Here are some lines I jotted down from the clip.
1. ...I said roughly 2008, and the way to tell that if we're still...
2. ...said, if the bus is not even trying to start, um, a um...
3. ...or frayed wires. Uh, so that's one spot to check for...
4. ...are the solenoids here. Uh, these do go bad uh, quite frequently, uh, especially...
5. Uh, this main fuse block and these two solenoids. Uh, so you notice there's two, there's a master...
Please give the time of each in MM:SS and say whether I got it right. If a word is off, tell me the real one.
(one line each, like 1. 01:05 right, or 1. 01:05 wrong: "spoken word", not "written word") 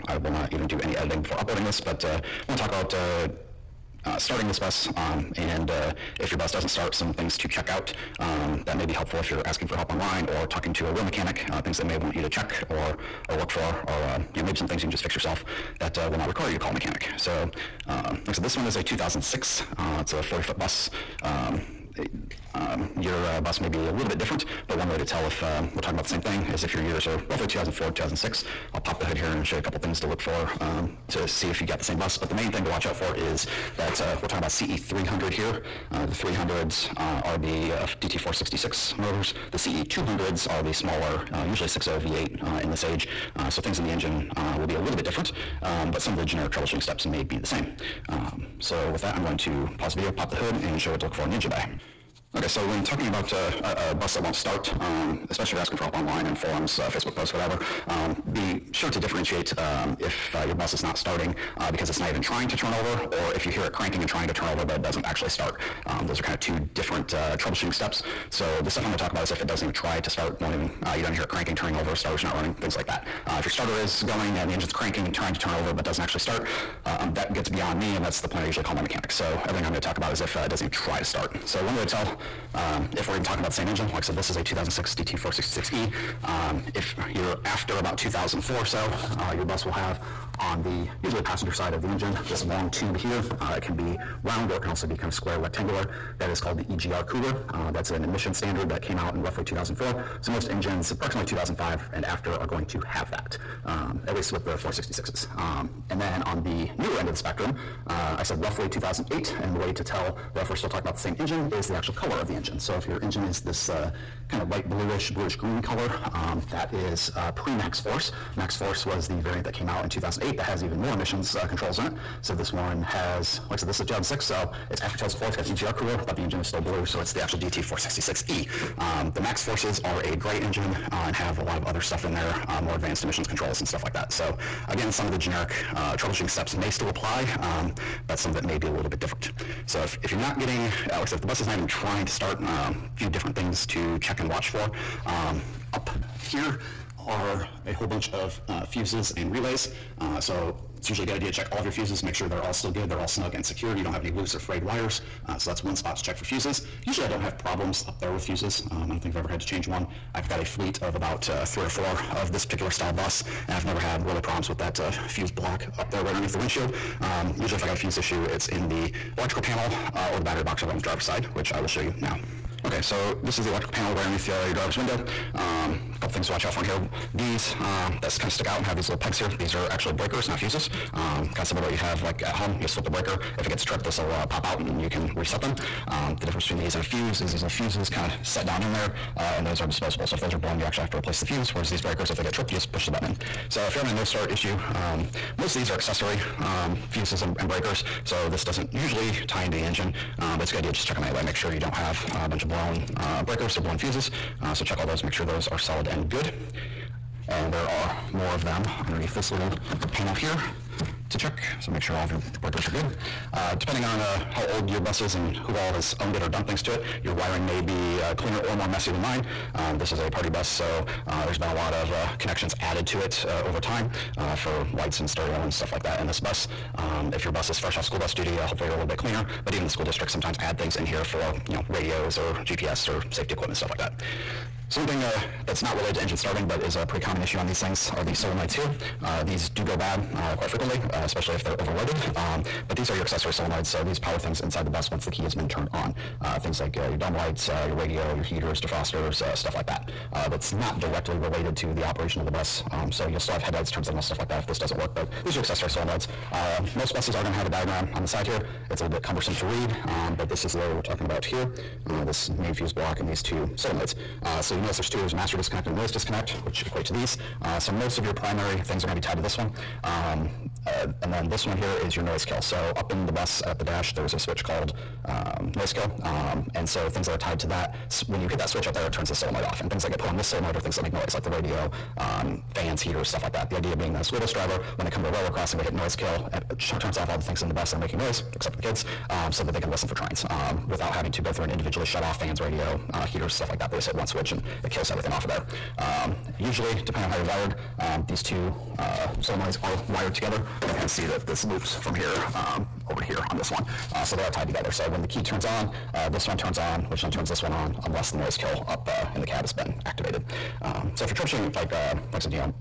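1. 01:48 right
2. 02:21 right
3. 02:34 right
4. 03:57 right
5. 04:21 right.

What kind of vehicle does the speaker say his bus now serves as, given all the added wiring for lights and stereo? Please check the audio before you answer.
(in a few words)
party bus.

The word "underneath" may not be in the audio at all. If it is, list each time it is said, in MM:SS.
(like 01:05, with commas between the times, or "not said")
02:46, 02:54, 03:28.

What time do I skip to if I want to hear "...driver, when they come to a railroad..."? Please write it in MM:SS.
04:44.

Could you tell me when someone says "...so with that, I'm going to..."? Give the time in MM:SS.
00:48.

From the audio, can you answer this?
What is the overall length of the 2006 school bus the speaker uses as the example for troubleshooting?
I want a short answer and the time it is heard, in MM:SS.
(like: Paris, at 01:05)
40 foot, at 00:20.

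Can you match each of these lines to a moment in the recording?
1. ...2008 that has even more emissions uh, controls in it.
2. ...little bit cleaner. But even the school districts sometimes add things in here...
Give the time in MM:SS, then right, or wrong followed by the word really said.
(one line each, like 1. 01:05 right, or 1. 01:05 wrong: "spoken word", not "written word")
1. 01:59 right
2. 03:48 right.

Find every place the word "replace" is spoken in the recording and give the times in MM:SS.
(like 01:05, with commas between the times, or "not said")
03:10.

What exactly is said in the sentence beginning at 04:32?
So up in the bus at the dash, there's a switch called um, noise kill.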